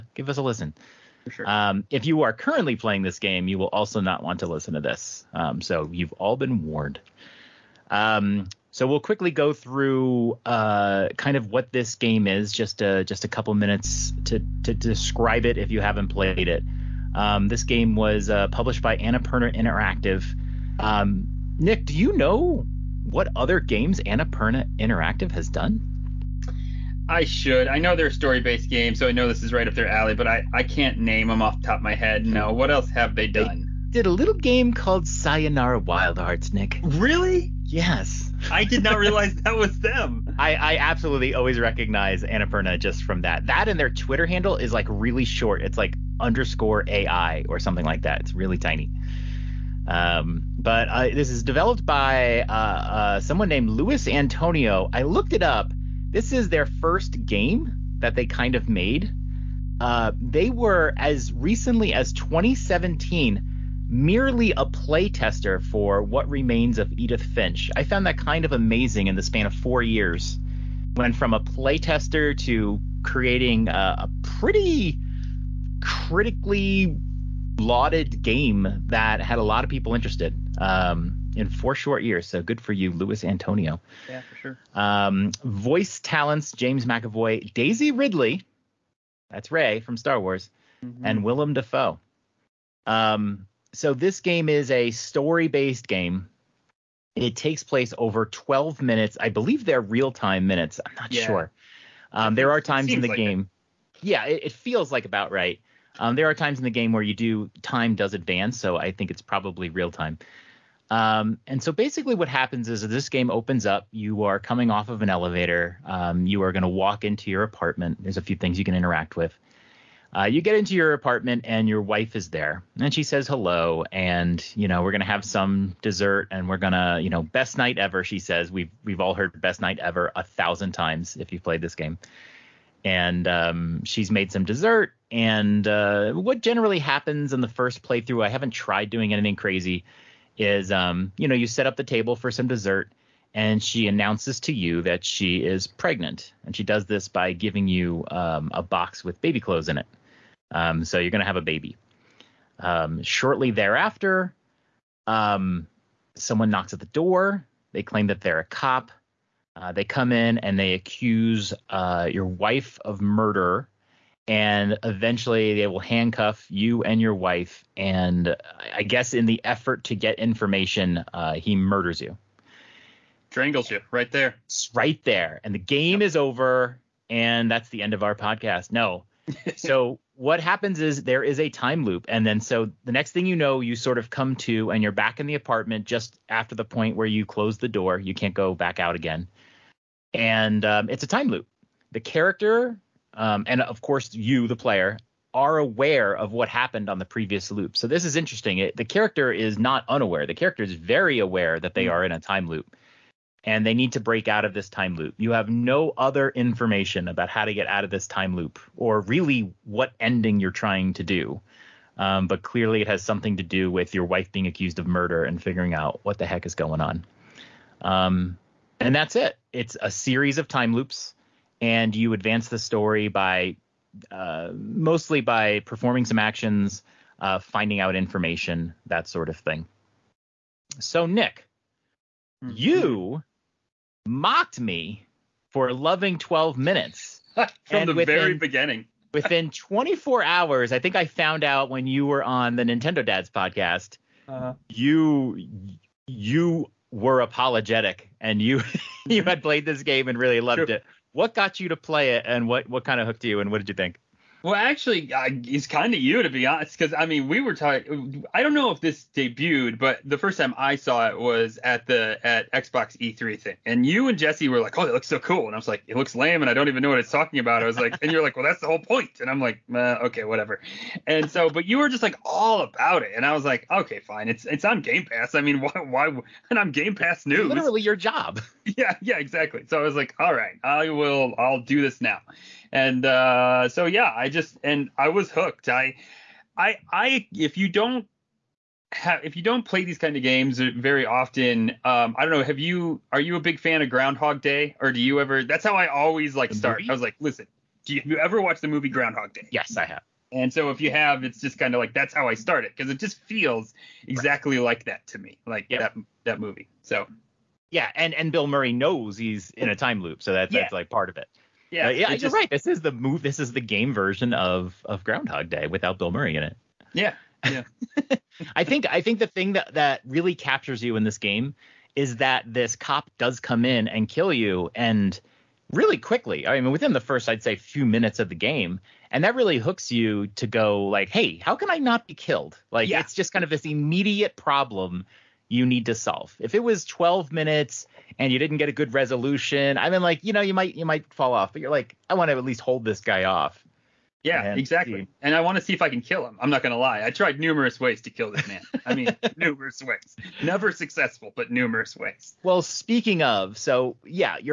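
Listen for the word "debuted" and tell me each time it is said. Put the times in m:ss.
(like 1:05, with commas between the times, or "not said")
4:19.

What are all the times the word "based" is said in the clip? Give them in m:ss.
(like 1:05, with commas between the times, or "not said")
0:28, 1:35.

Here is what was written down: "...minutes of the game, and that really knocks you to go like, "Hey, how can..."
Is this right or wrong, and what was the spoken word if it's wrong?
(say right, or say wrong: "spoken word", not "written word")
wrong: "hooks", not "knocks".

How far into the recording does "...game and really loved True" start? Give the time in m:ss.
4:09.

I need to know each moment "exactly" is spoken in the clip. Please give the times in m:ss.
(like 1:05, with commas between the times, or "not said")
4:39, 5:04, 5:44.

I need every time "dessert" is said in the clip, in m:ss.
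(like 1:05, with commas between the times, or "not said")
2:05, 2:14, 2:22.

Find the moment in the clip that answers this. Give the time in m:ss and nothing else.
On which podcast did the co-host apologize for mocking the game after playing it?
4:02.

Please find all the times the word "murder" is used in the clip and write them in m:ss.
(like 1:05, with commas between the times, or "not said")
2:43, 2:51, 3:34.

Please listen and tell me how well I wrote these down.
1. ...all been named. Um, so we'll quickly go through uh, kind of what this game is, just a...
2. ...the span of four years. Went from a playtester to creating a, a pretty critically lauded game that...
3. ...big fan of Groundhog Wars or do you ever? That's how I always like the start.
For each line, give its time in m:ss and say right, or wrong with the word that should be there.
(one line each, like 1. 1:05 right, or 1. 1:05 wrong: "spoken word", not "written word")
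1. 0:06 wrong: "warned", not "named"
2. 1:09 right
3. 4:53 wrong: "Day", not "Wars".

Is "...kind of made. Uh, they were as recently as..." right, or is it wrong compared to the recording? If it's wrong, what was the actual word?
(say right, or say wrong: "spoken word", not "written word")
right.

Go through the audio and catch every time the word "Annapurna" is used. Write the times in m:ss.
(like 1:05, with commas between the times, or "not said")
0:18, 0:24, 0:42.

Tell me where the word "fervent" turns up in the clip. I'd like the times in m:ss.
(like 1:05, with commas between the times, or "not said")
not said.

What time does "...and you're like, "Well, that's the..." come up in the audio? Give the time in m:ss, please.
4:28.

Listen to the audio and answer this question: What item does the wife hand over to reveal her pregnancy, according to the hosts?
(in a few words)
A box with baby clothes.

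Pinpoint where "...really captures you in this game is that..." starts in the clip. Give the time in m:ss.
5:20.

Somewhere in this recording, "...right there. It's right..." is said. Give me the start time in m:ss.
2:53.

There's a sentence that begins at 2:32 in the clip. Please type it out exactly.
Um, shortly thereafter, um, someone knocks at the door.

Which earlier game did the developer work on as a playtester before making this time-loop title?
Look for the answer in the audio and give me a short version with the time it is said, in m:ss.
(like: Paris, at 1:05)
What Remains of Edith Finch, at 1:06.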